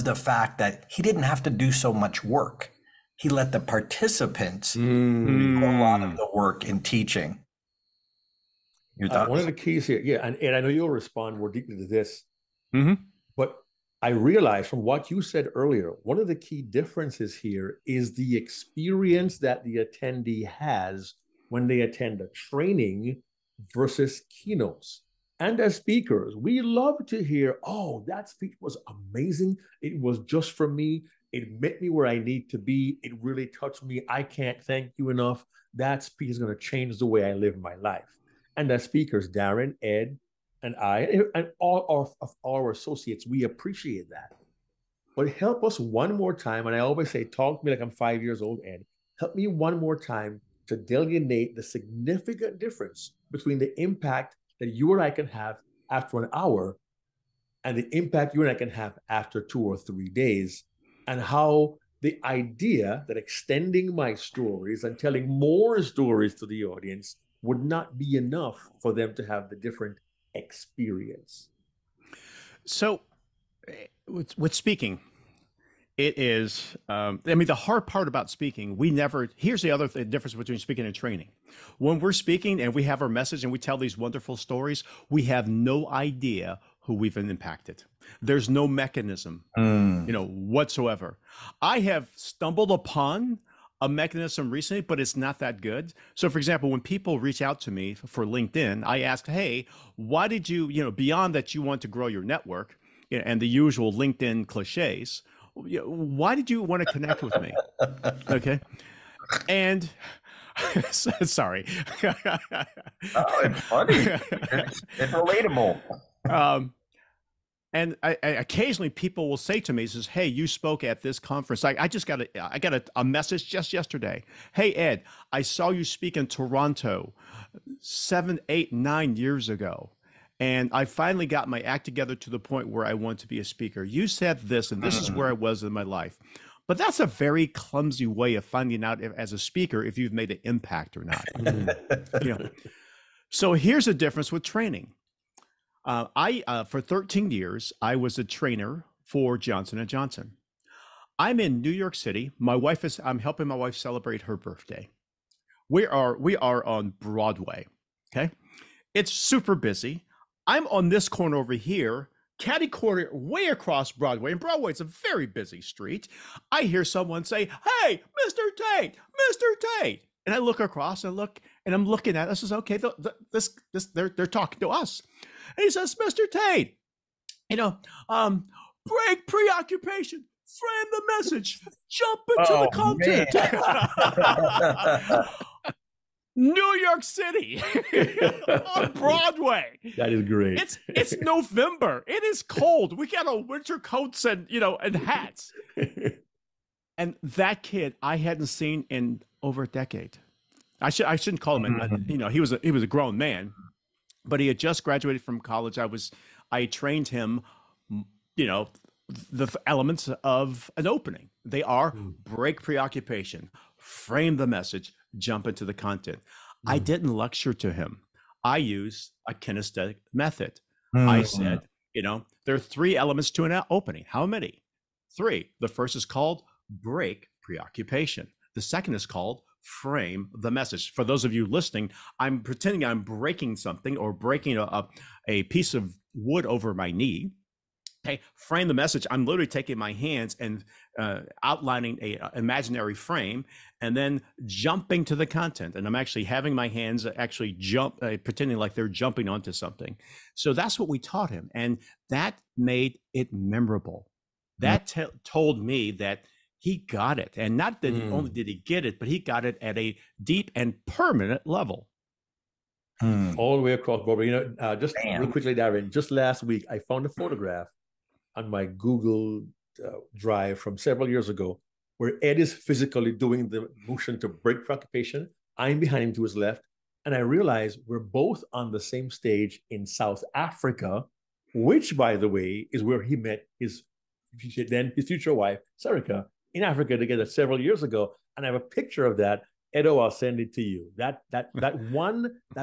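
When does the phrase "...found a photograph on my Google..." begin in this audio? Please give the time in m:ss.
4:26.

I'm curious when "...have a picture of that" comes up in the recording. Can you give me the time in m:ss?
4:48.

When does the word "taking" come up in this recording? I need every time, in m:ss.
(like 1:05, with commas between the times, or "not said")
3:59.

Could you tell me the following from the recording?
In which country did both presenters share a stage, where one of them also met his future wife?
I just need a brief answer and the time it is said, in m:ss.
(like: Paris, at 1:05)
South Africa, at 4:39.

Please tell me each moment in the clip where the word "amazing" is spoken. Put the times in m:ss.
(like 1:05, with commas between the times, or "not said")
0:28.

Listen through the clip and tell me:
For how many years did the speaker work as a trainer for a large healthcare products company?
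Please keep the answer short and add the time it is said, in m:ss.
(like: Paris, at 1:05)
13, at 2:26.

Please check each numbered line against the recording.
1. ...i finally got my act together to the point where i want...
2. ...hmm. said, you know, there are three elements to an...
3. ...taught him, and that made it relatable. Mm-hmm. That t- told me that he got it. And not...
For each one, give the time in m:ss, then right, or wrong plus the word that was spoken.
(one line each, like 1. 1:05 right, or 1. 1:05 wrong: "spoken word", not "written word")
1. 2:10 right
2. 3:41 right
3. 4:10 wrong: "memorable", not "relatable".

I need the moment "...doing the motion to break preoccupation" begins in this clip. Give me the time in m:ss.
4:33.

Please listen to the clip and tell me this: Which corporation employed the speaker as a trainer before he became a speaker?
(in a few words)
Johnson and Johnson.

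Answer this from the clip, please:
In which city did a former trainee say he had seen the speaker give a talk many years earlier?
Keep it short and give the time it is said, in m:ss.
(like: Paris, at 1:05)
Toronto, at 2:06.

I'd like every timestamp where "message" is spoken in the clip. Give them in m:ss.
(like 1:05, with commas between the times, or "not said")
1:23, 2:03, 3:01, 3:34, 3:50, 3:58.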